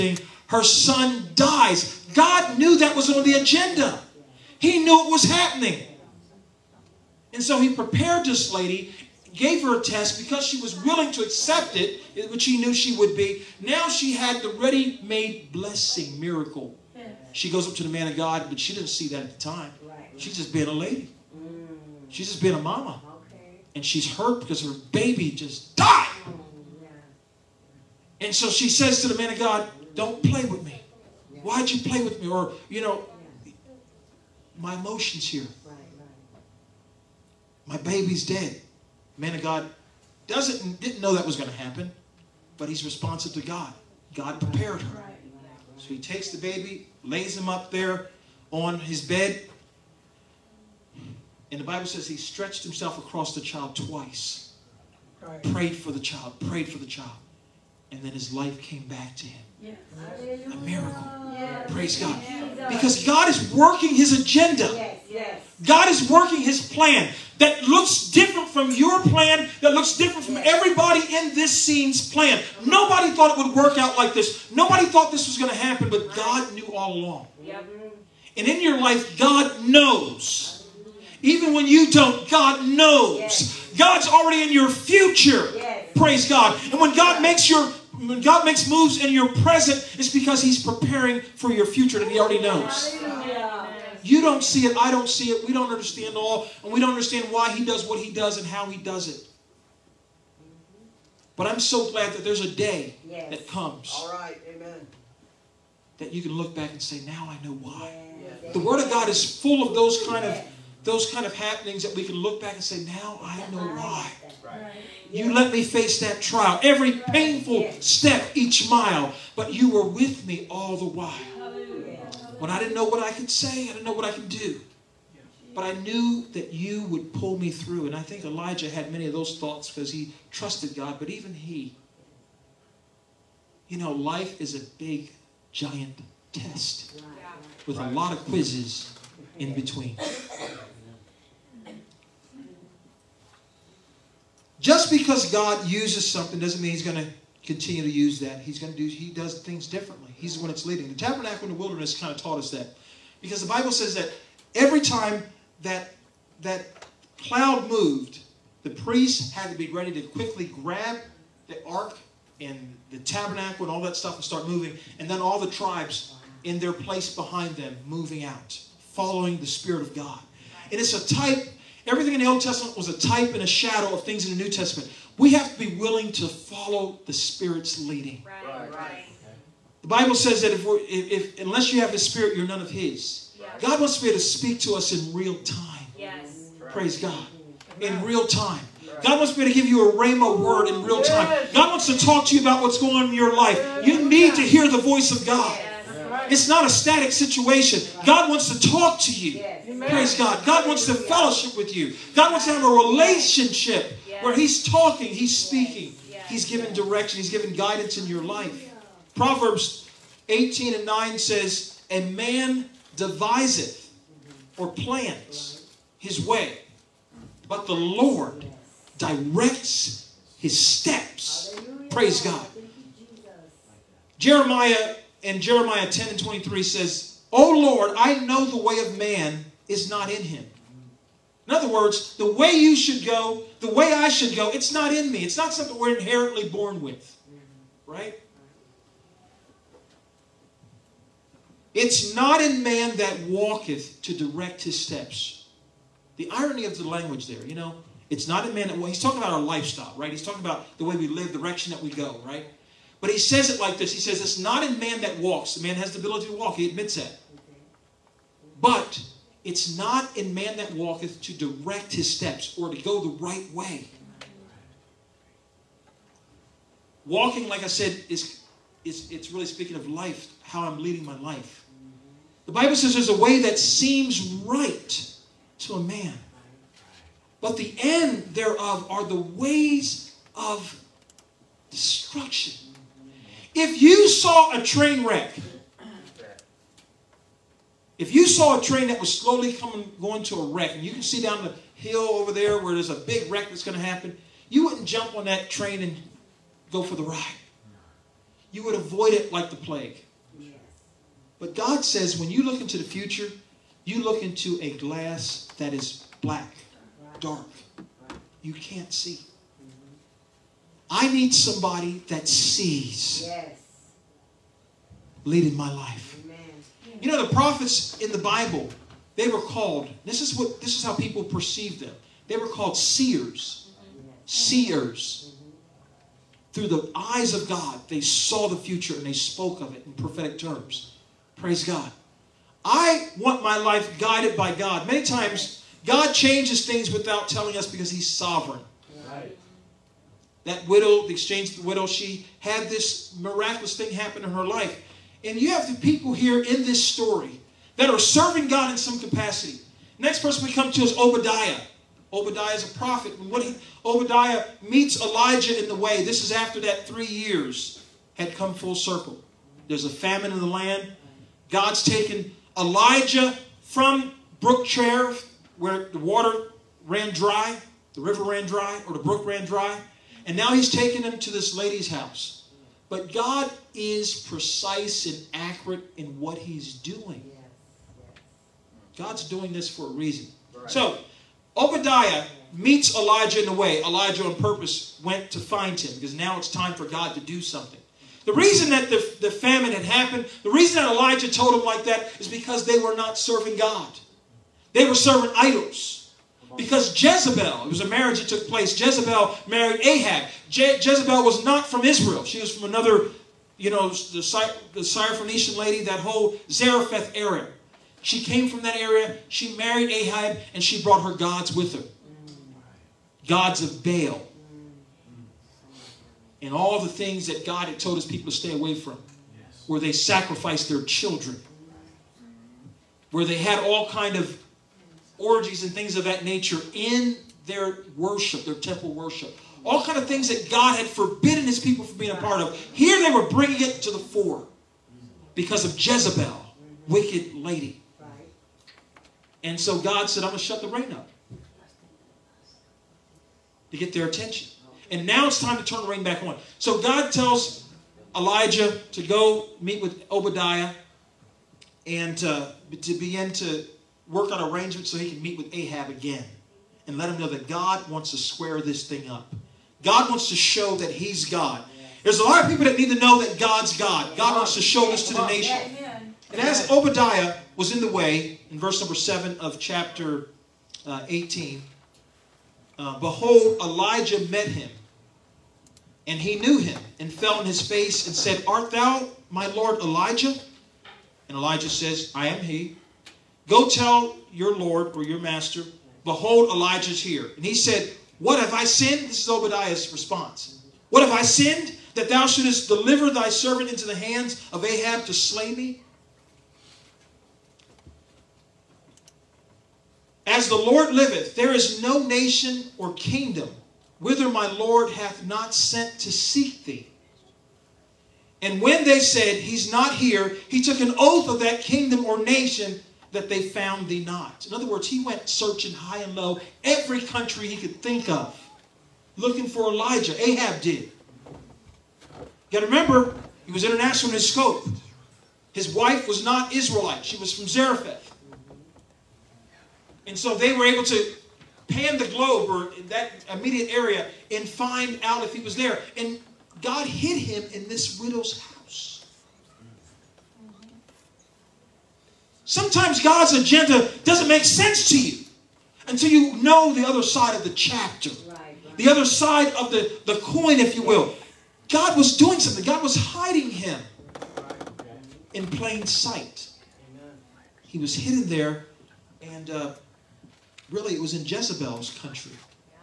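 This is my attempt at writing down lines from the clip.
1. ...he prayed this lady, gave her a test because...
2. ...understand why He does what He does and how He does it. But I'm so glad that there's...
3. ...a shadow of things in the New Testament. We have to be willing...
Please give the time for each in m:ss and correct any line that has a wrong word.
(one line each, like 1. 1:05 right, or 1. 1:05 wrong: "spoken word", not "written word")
1. 0:07 wrong: "prepared", not "prayed"
2. 1:36 right
3. 2:53 right.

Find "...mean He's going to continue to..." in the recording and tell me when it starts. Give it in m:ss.
2:26.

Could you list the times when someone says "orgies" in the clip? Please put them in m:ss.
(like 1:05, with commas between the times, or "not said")
7:05.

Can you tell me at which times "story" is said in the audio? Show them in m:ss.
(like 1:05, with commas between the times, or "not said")
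5:46.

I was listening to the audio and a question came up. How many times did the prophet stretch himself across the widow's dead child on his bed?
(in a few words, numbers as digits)
twice.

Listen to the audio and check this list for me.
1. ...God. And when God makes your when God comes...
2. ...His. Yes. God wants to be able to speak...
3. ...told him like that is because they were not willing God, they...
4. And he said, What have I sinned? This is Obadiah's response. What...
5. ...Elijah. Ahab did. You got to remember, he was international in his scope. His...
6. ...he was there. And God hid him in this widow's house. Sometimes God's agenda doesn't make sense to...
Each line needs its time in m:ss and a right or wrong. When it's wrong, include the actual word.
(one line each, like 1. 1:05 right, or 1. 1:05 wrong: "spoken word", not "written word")
1. 1:26 wrong: "makes", not "comes"
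2. 3:02 right
3. 6:31 wrong: "serving", not "willing"
4. 8:07 right
5. 8:39 right
6. 8:55 right.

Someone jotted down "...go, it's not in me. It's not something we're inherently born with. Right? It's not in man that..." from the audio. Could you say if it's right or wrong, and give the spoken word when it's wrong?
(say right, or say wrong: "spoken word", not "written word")
right.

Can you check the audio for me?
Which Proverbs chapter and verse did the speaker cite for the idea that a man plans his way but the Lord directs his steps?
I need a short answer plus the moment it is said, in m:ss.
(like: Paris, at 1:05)
Proverbs 18:9, at 3:29.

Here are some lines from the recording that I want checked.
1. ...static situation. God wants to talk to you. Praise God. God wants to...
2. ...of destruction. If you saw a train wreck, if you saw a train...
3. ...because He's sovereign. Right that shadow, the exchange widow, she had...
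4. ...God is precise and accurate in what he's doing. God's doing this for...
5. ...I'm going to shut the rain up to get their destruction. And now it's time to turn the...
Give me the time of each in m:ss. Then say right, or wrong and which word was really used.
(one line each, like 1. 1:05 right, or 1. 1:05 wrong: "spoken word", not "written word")
1. 3:16 right
2. 4:40 right
3. 5:37 wrong: "widow", not "shadow"
4. 6:13 right
5. 7:20 wrong: "attention", not "destruction".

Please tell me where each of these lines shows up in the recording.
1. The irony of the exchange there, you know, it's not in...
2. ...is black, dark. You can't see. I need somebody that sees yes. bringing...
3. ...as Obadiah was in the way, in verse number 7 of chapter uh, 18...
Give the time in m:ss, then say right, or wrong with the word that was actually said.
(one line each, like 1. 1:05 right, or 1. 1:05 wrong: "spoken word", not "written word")
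1. 4:06 wrong: "language", not "exchange"
2. 5:05 wrong: "leading", not "bringing"
3. 7:46 right.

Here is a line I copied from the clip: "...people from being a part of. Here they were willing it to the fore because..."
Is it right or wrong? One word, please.
wrong.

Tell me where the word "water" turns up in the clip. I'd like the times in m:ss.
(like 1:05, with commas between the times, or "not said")
6:05.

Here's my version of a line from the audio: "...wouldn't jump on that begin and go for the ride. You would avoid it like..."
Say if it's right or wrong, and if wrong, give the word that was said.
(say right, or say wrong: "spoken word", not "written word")
wrong: "train", not "begin".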